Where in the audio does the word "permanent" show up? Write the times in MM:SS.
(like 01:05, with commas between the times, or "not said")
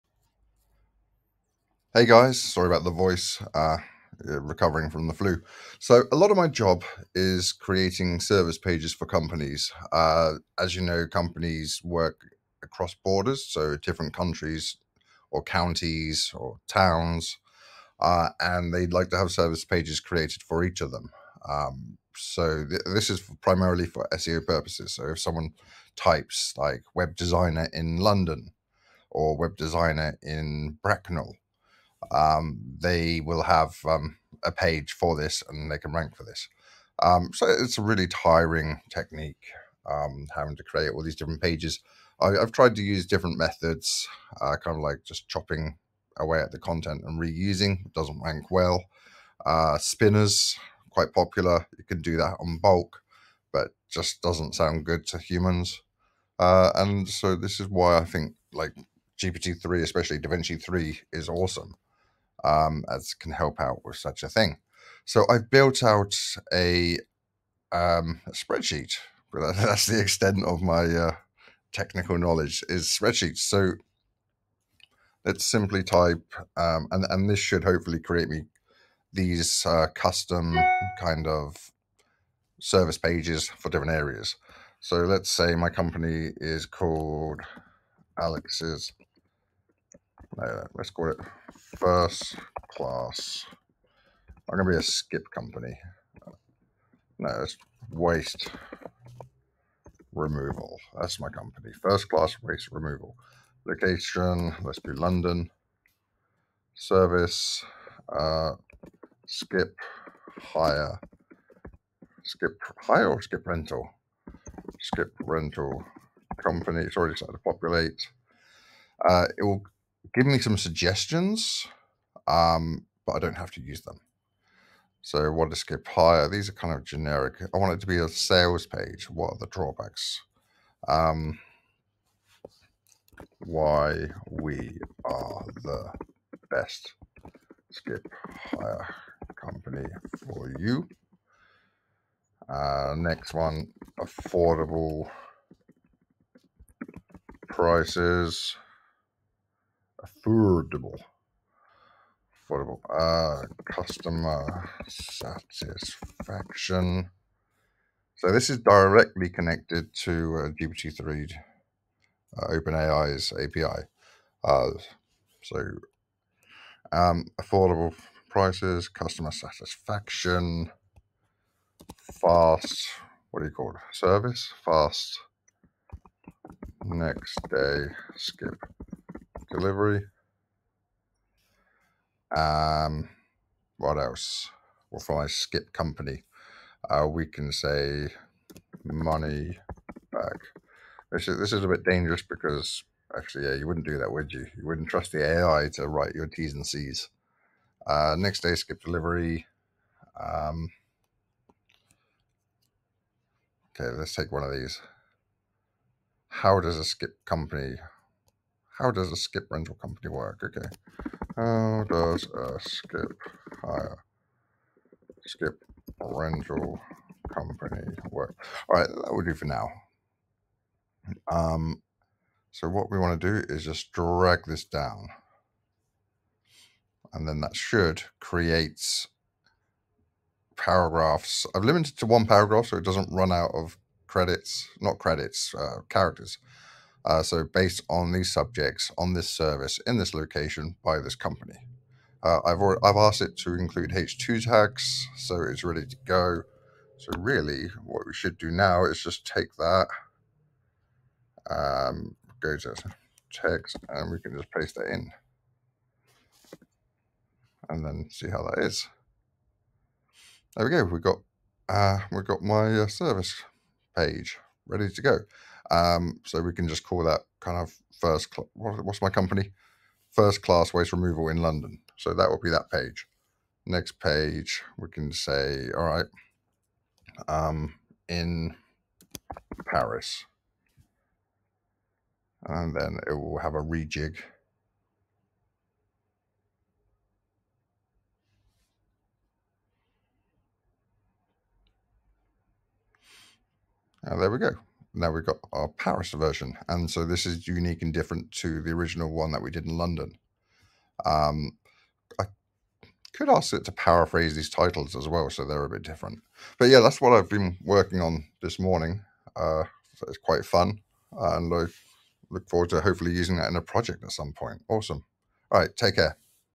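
not said.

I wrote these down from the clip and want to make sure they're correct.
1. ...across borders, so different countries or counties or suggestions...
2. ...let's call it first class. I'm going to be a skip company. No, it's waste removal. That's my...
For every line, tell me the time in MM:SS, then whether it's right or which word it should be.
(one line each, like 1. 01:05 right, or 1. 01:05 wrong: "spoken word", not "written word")
1. 00:12 wrong: "towns", not "suggestions"
2. 01:30 right.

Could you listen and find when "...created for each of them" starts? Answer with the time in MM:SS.
00:19.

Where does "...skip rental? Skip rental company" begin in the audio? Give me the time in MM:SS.
01:53.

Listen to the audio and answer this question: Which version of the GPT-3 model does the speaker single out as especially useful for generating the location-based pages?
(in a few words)
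DaVinci 3.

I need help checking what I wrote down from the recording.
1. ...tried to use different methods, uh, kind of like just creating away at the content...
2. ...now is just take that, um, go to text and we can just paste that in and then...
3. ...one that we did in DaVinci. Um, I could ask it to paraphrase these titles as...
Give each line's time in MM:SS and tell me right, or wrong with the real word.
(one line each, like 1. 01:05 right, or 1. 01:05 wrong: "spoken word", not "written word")
1. 00:42 wrong: "chopping", not "creating"
2. 04:08 right
3. 04:59 wrong: "London", not "DaVinci".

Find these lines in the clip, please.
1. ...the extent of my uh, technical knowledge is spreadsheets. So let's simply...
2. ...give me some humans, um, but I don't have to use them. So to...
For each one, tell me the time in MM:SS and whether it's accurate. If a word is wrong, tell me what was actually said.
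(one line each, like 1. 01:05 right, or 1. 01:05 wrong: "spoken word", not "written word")
1. 01:09 right
2. 02:00 wrong: "suggestions", not "humans".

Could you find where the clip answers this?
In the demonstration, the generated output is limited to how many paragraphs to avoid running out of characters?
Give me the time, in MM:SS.
03:52.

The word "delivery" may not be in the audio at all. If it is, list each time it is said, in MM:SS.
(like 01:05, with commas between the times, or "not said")
02:59, 03:18.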